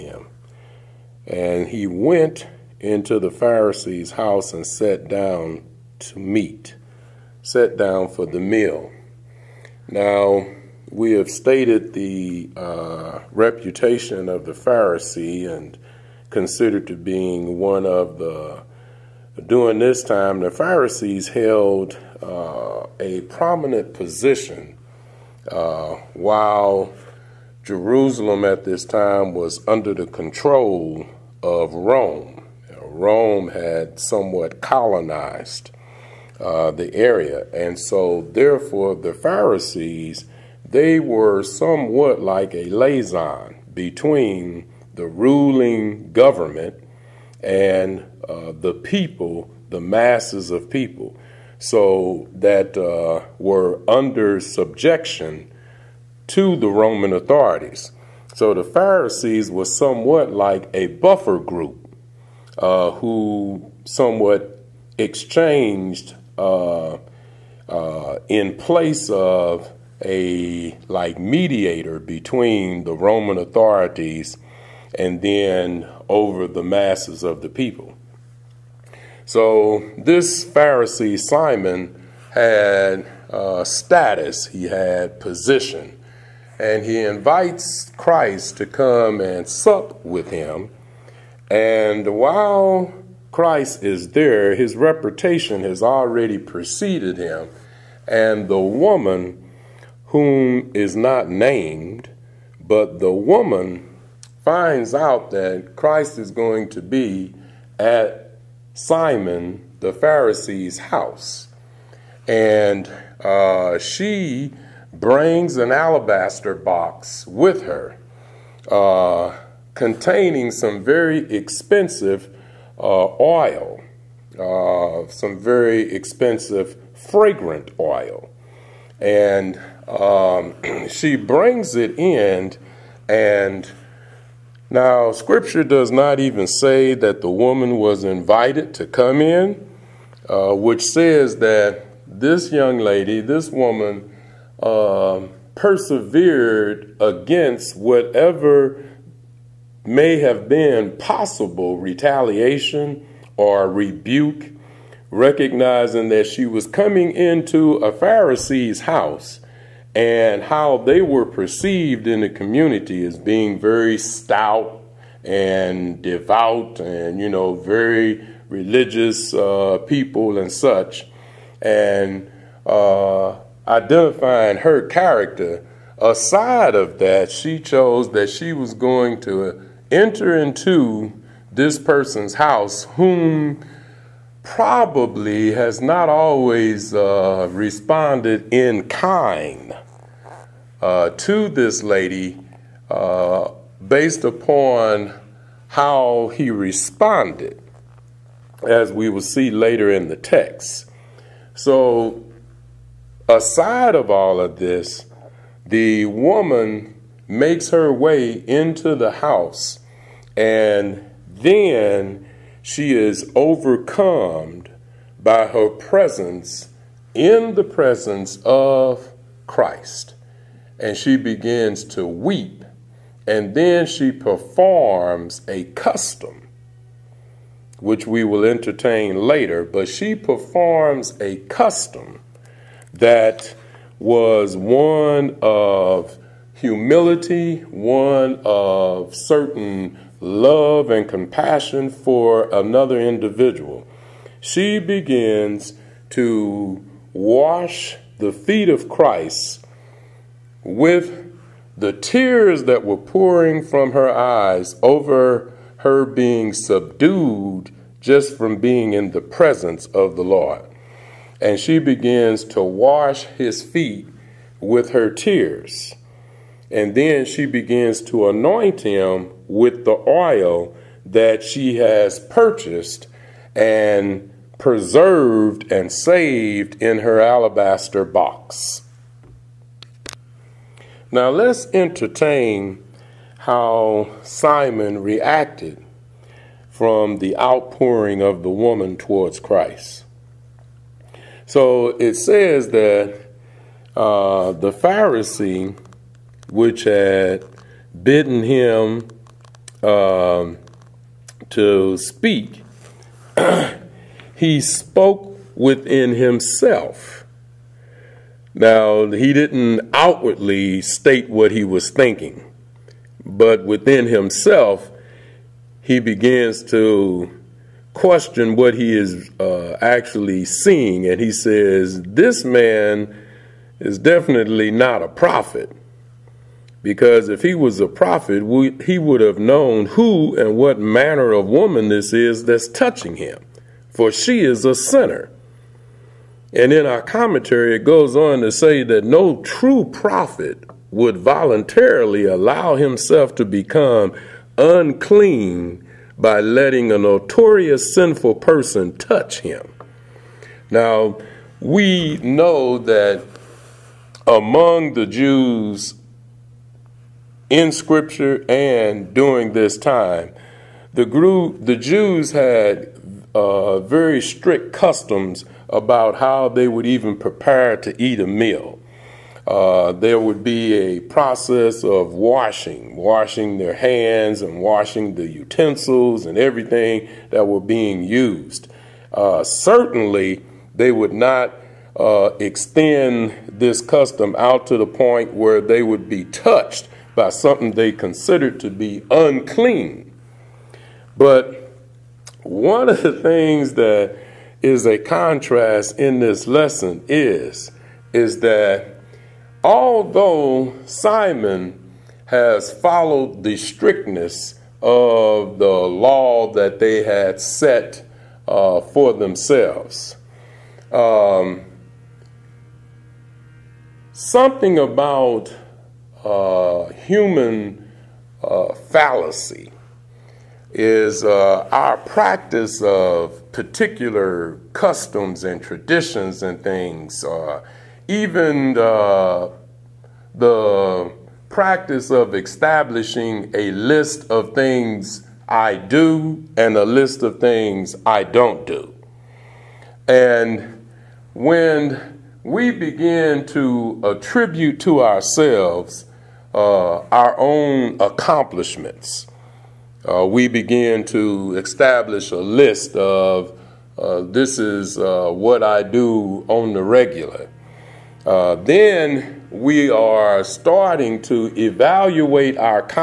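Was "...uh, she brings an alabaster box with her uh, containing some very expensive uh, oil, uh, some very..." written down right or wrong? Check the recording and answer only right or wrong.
right.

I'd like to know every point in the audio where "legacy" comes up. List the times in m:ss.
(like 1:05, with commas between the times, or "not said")
not said.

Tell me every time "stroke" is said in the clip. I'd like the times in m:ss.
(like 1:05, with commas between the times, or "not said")
not said.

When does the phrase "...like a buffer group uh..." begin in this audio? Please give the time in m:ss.
1:00.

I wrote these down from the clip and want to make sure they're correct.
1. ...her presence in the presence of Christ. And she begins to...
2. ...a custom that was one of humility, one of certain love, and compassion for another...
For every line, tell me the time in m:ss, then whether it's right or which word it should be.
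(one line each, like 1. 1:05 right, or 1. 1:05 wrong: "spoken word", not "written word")
1. 3:35 right
2. 3:51 right.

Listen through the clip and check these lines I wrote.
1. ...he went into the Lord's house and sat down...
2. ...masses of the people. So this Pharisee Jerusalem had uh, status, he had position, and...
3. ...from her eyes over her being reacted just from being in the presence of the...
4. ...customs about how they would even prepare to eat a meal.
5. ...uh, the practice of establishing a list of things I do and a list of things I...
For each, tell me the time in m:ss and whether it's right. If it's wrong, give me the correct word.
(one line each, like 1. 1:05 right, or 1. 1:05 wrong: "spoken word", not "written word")
1. 0:01 wrong: "Pharisee", not "Lord"
2. 1:16 wrong: "Simon", not "Jerusalem"
3. 4:13 wrong: "subdued", not "reacted"
4. 6:04 right
5. 7:08 right.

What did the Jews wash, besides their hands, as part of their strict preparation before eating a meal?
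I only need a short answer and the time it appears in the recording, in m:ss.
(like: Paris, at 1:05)
utensils, at 6:15.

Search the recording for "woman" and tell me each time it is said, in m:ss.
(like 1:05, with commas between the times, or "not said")
1:38, 1:43, 2:17, 2:23, 3:26, 4:48, 5:31.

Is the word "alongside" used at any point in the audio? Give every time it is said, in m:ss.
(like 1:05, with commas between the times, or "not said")
not said.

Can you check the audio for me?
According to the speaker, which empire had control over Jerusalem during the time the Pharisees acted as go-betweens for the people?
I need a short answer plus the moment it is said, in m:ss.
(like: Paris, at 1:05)
Rome, at 0:31.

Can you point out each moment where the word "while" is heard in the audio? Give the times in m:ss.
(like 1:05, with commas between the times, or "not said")
0:26, 1:32.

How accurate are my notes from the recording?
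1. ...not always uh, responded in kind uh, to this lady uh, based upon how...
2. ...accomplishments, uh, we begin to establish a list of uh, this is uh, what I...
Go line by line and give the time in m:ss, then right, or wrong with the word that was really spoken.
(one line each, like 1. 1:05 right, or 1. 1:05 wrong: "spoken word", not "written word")
1. 3:05 right
2. 7:28 right.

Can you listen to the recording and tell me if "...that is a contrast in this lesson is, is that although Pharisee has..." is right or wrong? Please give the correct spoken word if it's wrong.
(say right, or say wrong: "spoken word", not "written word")
wrong: "Simon", not "Pharisee".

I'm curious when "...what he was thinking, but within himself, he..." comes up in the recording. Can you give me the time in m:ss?
5:11.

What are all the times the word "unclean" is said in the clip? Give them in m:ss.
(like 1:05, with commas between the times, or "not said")
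5:44, 6:29.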